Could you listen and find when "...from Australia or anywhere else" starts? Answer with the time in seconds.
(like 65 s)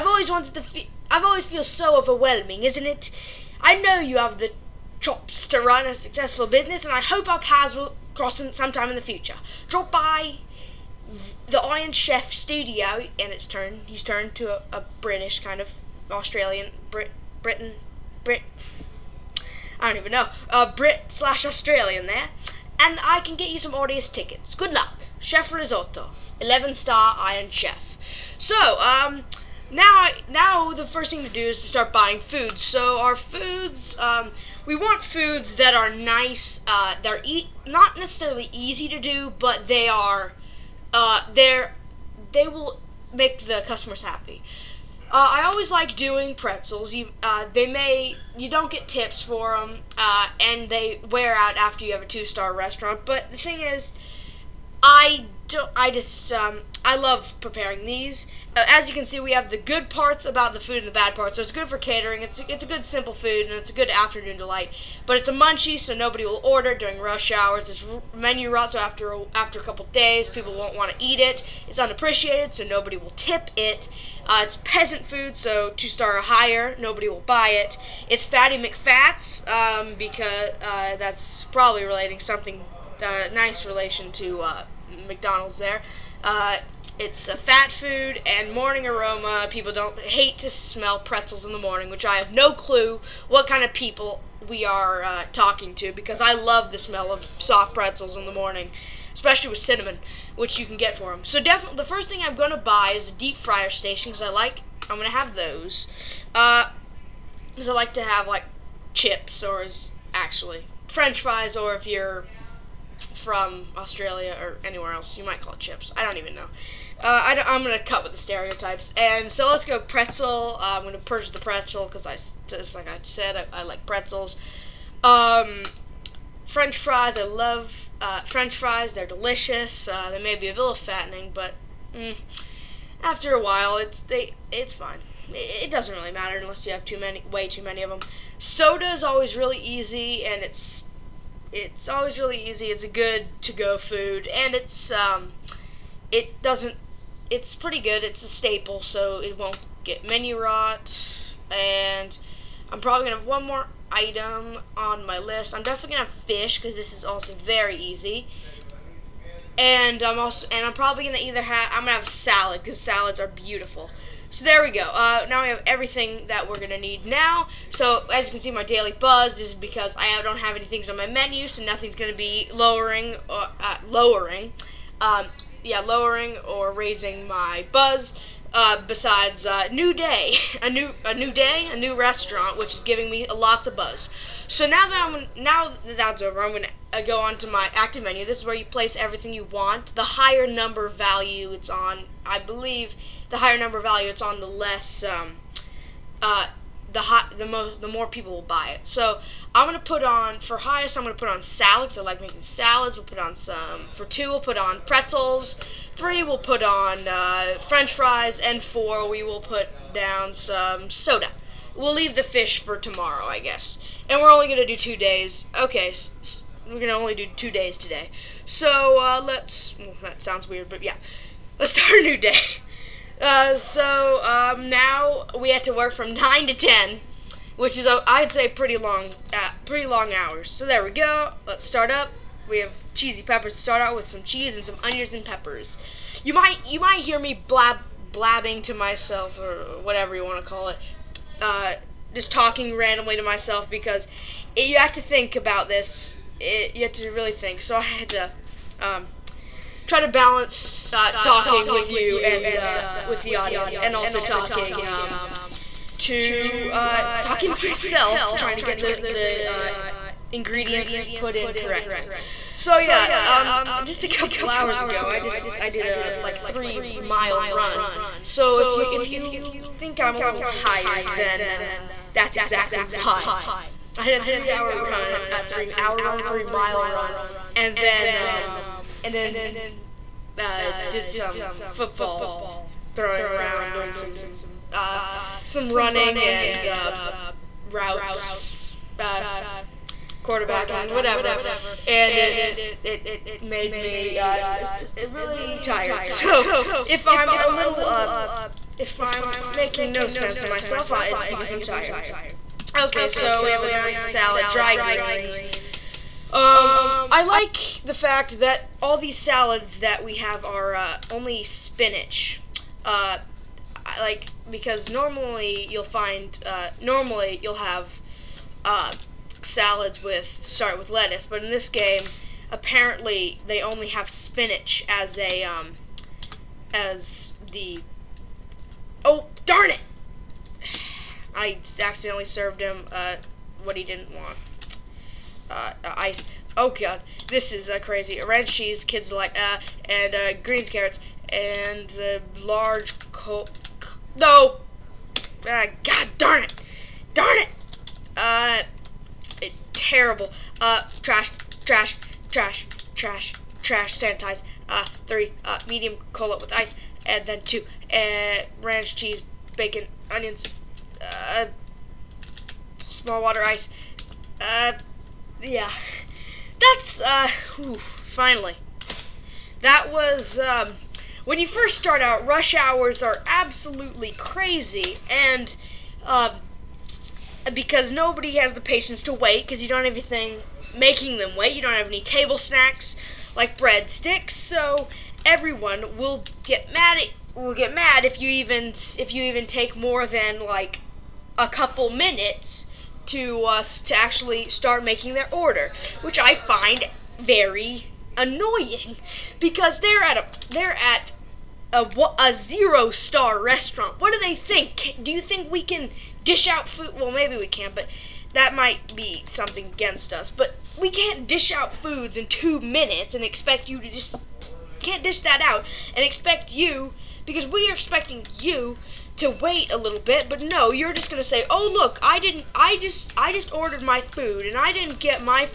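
113 s.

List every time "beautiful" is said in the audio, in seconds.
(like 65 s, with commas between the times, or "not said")
163 s.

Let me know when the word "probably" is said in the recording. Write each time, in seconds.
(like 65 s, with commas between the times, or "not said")
81 s, 152 s, 160 s.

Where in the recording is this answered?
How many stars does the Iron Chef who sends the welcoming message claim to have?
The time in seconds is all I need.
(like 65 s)
26 s.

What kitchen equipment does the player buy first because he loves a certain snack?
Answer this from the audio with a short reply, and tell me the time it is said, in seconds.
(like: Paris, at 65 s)
deep fryer station, at 103 s.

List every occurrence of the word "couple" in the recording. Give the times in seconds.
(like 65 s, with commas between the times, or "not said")
69 s, 264 s, 391 s.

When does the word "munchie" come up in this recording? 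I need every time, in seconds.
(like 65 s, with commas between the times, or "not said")
65 s.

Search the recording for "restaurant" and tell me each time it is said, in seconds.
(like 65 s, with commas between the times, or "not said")
52 s, 181 s, 403 s.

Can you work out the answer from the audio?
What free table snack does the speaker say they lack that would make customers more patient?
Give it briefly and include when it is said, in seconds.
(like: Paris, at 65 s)
breadsticks, at 383 s.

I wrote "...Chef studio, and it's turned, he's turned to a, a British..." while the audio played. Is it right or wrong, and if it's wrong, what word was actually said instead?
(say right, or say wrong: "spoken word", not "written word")
right.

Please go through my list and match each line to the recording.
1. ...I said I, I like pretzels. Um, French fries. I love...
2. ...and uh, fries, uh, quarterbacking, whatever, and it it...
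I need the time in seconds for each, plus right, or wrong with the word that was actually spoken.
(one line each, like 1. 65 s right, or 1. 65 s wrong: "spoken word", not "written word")
1. 122 s right
2. 286 s wrong: "routes", not "fries".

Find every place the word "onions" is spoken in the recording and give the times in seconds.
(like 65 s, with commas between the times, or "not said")
234 s, 360 s.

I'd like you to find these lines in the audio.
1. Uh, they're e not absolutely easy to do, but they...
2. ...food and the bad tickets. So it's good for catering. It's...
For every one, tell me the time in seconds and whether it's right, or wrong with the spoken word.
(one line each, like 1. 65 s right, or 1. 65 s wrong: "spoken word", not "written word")
1. 36 s wrong: "necessarily", not "absolutely"
2. 60 s wrong: "parts", not "tickets".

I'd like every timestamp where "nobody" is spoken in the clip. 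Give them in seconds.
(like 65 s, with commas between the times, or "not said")
65 s, 72 s, 76 s, 377 s.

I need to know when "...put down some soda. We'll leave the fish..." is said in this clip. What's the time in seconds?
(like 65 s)
209 s.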